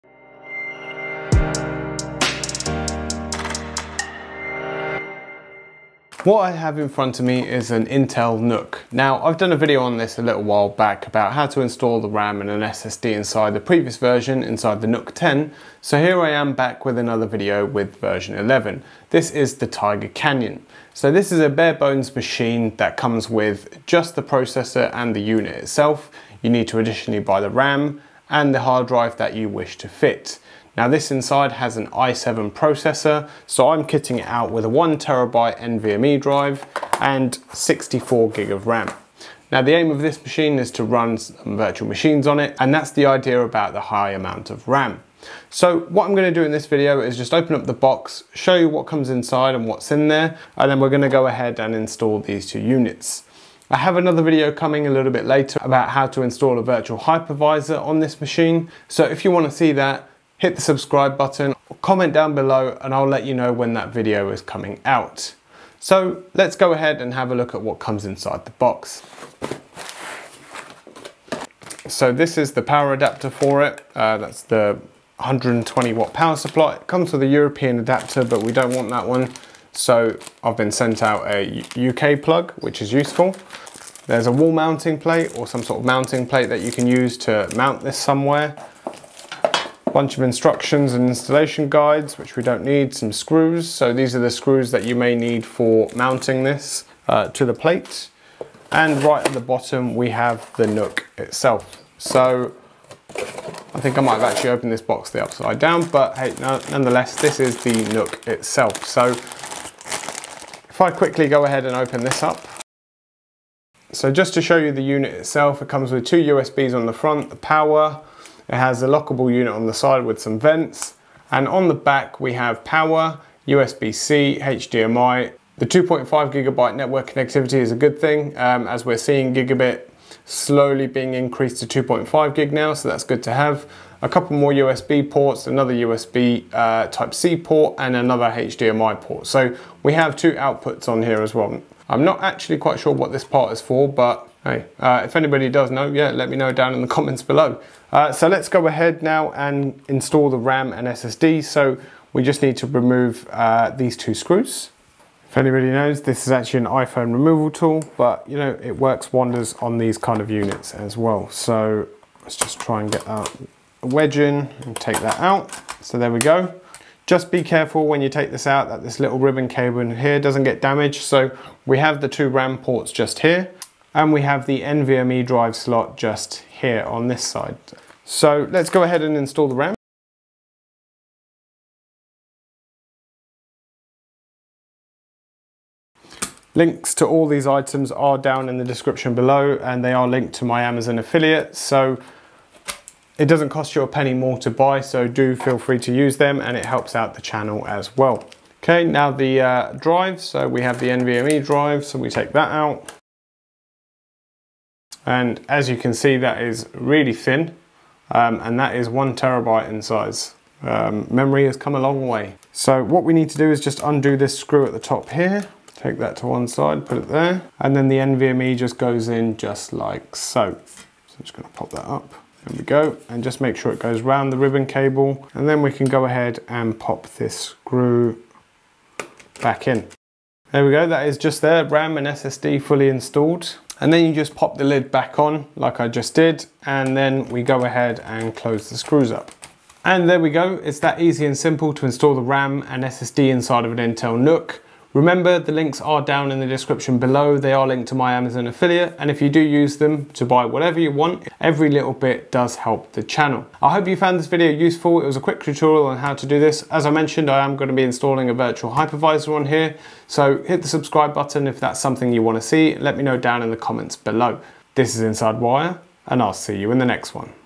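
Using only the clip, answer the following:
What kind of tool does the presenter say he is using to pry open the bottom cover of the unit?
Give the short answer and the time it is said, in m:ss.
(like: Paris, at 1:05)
iPhone removal tool, at 2:36.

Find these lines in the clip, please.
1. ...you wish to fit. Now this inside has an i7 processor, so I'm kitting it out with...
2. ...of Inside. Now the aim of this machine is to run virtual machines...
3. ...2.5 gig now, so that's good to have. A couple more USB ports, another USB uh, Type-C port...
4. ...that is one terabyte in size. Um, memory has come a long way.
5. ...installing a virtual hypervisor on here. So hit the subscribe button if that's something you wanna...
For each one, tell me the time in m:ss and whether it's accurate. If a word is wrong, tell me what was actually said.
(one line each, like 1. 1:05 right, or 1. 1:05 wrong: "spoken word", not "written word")
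1. 0:29 right
2. 0:38 wrong: "RAM", not "Inside"
3. 2:11 right
4. 3:28 right
5. 4:17 right.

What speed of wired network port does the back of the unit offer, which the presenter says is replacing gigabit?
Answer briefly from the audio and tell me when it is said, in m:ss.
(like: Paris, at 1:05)
2.5 gigabyte, at 2:05.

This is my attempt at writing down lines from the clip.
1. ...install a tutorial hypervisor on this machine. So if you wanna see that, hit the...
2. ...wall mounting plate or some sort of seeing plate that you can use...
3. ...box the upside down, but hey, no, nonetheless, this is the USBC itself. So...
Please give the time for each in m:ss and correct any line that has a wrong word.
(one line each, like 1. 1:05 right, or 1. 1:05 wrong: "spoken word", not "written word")
1. 0:56 wrong: "virtual", not "tutorial"
2. 1:24 wrong: "mounting", not "seeing"
3. 1:44 wrong: "NUC", not "USBC".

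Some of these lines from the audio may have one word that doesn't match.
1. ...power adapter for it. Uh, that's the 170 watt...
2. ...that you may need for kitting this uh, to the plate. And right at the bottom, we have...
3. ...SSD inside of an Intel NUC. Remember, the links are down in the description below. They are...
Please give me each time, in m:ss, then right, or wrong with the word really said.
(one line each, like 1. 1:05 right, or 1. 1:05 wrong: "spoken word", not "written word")
1. 1:12 wrong: "120", not "170"
2. 1:34 wrong: "mounting", not "kitting"
3. 4:02 right.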